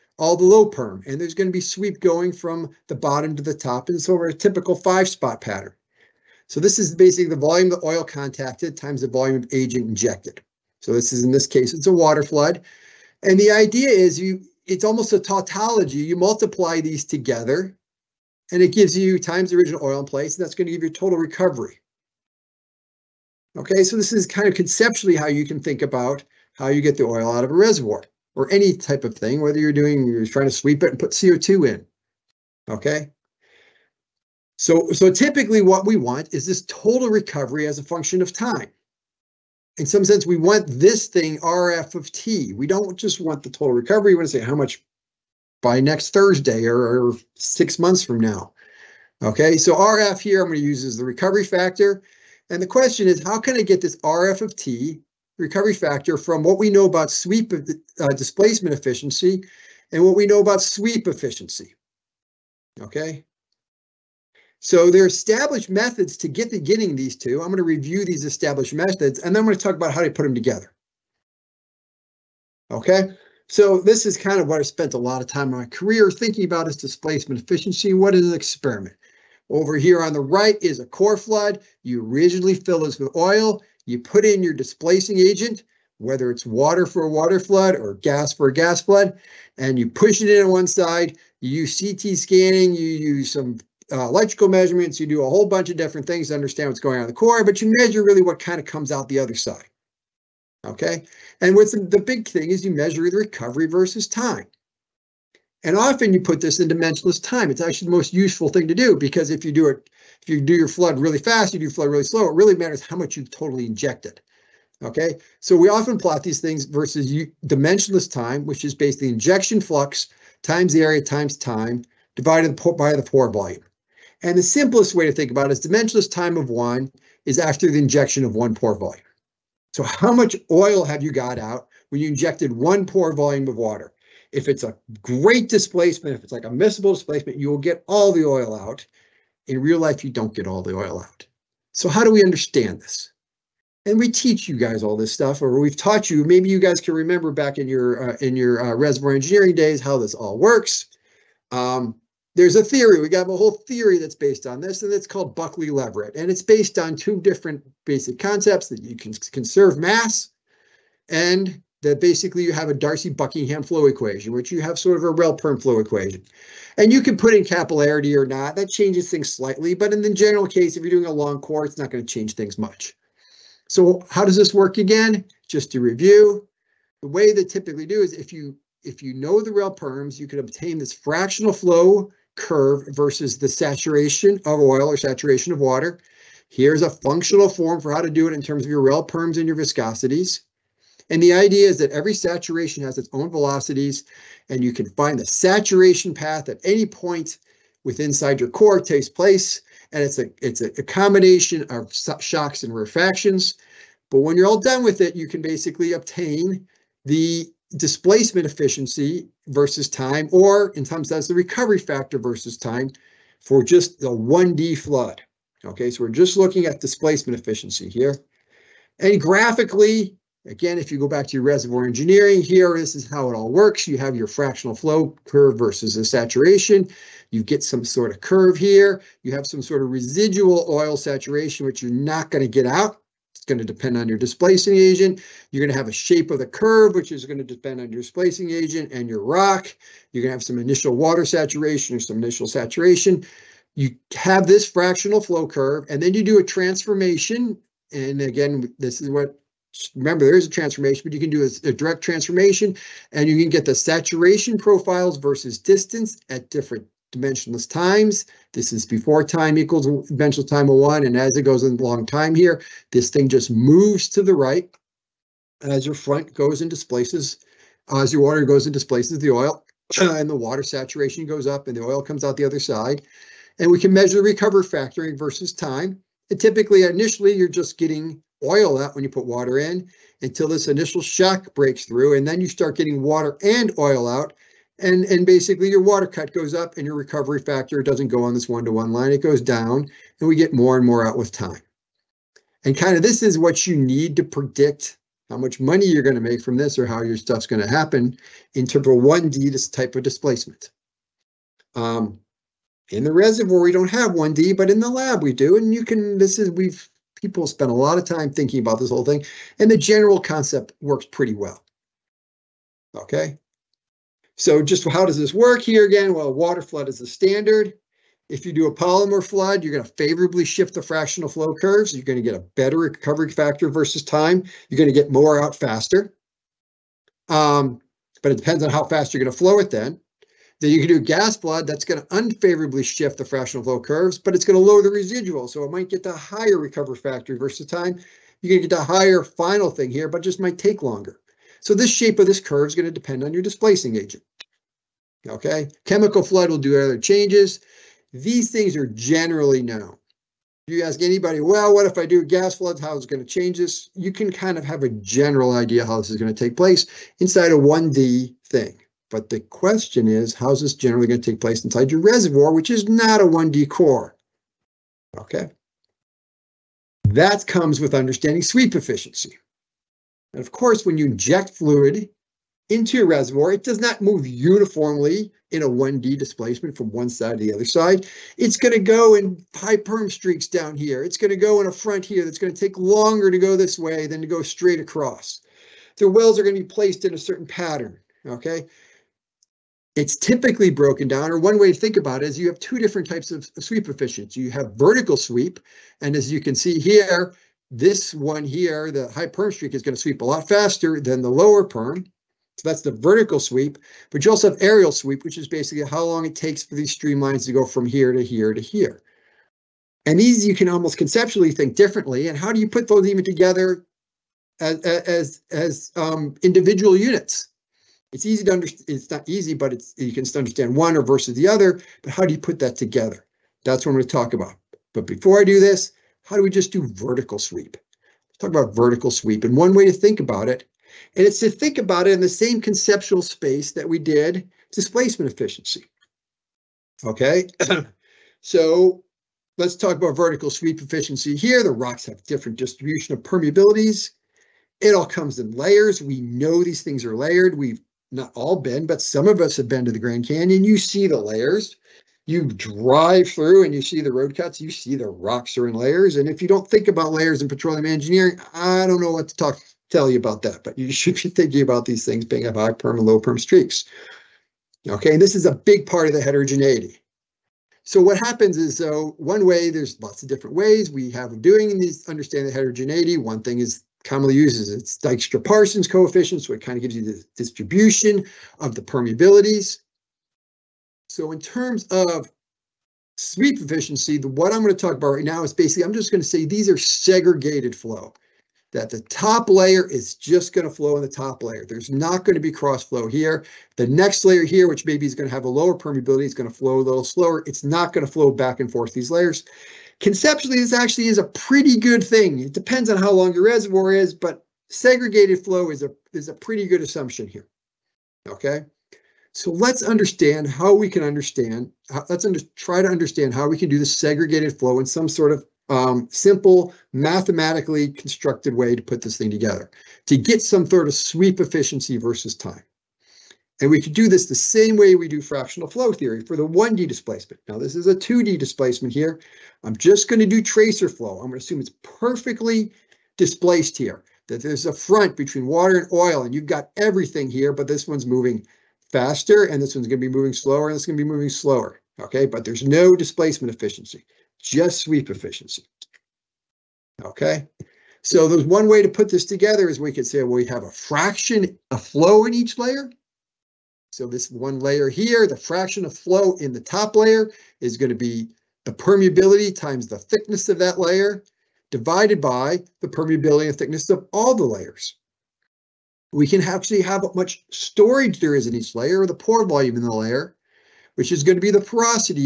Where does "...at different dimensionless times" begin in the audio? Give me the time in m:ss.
4:16.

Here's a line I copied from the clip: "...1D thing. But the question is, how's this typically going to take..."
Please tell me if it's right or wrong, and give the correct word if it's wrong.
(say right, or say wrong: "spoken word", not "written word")
wrong: "generally", not "typically".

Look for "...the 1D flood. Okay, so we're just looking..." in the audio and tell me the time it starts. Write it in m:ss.
3:33.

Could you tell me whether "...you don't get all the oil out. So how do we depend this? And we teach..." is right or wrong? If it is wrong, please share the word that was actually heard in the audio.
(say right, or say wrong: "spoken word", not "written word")
wrong: "understand", not "depend".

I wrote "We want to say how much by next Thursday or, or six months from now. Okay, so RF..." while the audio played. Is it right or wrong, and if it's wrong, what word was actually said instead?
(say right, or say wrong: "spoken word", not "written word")
right.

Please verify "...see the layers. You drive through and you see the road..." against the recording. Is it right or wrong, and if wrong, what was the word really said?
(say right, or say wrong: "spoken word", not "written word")
right.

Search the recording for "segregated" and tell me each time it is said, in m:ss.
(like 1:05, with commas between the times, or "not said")
8:06, 8:24, 8:33.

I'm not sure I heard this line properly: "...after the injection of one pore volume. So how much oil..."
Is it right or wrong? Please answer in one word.
right.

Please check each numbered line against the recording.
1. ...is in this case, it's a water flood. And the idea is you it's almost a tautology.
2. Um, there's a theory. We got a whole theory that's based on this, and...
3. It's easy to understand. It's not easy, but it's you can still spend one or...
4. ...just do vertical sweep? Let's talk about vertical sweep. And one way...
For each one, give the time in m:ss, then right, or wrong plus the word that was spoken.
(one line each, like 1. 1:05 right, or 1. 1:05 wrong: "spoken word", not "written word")
1. 0:11 right
2. 2:31 right
3. 6:58 wrong: "understand", not "spend"
4. 7:06 right.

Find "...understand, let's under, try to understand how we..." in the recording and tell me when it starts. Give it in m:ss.
8:31.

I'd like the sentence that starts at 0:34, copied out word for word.
So, so typically what we want is this total recovery as a function of time.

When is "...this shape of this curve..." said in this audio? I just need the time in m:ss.
5:41.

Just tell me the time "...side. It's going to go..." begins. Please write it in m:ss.
6:17.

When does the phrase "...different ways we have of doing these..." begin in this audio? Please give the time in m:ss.
7:50.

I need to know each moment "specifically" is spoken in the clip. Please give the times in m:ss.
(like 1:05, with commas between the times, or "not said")
not said.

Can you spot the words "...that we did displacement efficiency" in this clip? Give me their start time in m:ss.
7:13.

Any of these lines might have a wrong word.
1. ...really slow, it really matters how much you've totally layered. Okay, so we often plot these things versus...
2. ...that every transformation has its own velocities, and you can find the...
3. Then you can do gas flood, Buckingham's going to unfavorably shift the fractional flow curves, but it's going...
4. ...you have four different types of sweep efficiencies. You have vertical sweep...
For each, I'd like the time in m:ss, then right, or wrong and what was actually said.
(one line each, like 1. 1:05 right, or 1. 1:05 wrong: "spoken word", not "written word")
1. 1:51 wrong: "injected", not "layered"
2. 3:11 wrong: "saturation", not "transformation"
3. 5:30 wrong: "That", not "Buckingham"
4. 6:32 wrong: "two", not "four".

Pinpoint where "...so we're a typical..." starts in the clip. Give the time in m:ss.
0:04.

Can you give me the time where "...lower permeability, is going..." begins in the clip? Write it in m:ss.
8:15.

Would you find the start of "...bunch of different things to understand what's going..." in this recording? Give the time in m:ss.
1:35.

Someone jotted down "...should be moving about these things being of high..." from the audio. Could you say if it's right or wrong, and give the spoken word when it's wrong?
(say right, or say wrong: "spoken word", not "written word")
wrong: "thinking", not "moving".